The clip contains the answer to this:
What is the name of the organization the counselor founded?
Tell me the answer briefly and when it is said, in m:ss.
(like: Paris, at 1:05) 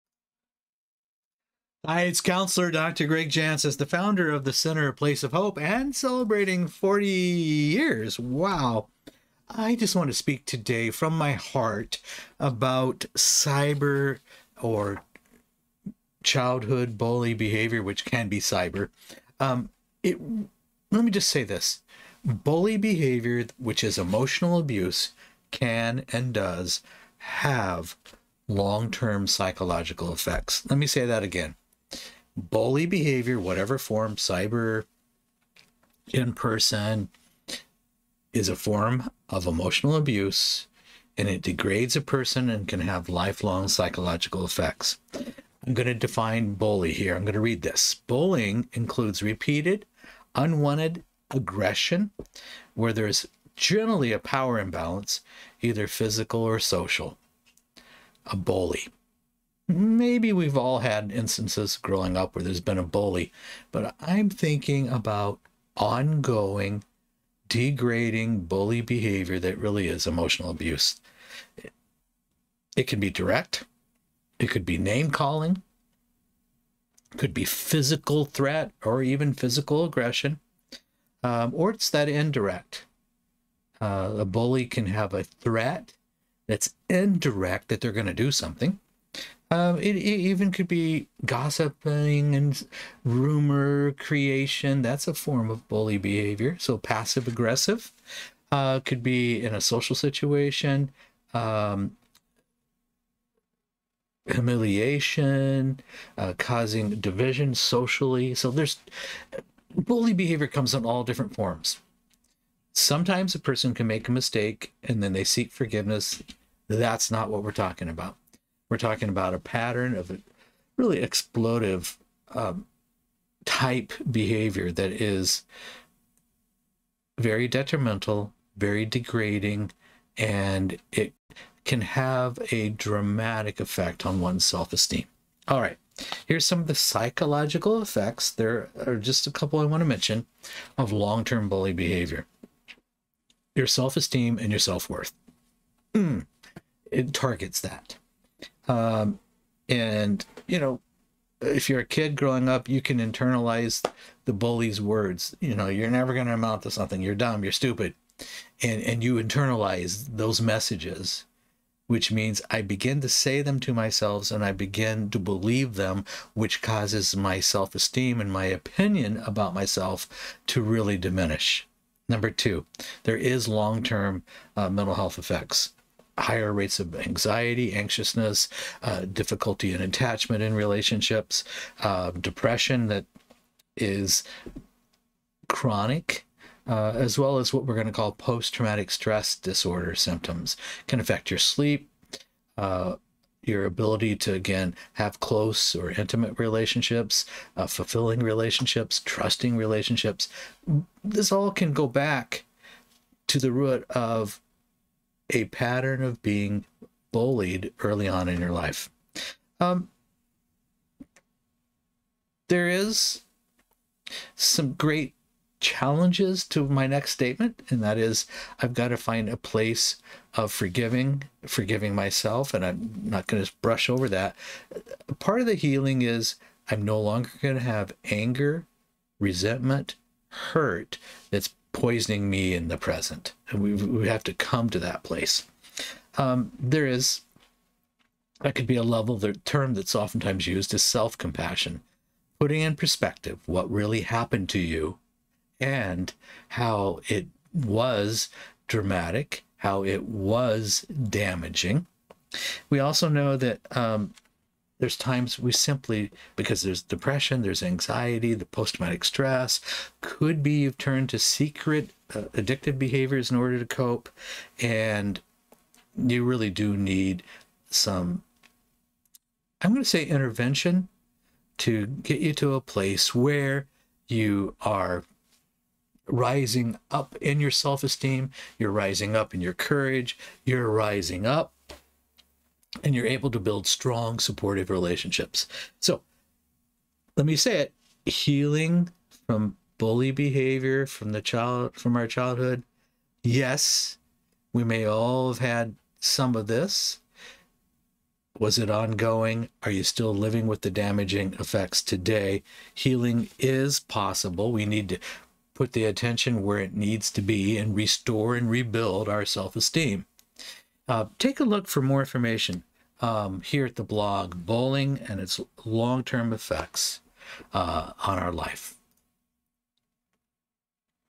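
The Center Place of Hope, at 0:04.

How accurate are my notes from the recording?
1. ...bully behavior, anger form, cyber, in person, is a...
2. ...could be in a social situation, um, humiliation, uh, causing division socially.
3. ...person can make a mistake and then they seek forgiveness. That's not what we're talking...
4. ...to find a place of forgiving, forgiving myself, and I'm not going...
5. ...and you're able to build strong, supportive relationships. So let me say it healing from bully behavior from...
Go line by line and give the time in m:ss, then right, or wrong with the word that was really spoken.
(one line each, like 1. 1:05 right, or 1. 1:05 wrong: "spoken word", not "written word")
1. 0:32 wrong: "whatever", not "anger"
2. 1:38 right
3. 1:53 right
4. 3:38 right
5. 4:42 right.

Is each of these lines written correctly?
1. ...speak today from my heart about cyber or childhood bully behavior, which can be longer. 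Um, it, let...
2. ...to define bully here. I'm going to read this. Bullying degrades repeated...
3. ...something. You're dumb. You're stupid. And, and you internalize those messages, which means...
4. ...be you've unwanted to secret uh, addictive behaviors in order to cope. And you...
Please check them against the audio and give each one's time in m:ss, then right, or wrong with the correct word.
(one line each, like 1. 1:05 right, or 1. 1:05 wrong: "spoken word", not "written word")
1. 0:10 wrong: "cyber", not "longer"
2. 0:45 wrong: "includes", not "degrades"
3. 2:36 right
4. 4:20 wrong: "turned", not "unwanted".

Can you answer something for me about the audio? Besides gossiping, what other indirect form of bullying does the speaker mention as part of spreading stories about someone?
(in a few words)
Rumor creation.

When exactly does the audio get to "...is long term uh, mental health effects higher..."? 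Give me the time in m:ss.
2:53.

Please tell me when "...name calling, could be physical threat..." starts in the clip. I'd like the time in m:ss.
1:14.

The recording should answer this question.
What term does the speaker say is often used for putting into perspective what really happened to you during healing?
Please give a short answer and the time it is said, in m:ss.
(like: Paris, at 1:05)
Self compassion, at 4:00.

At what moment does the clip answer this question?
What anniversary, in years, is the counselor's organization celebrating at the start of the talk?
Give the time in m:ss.
0:06.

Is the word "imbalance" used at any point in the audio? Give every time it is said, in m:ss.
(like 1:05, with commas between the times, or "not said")
0:54.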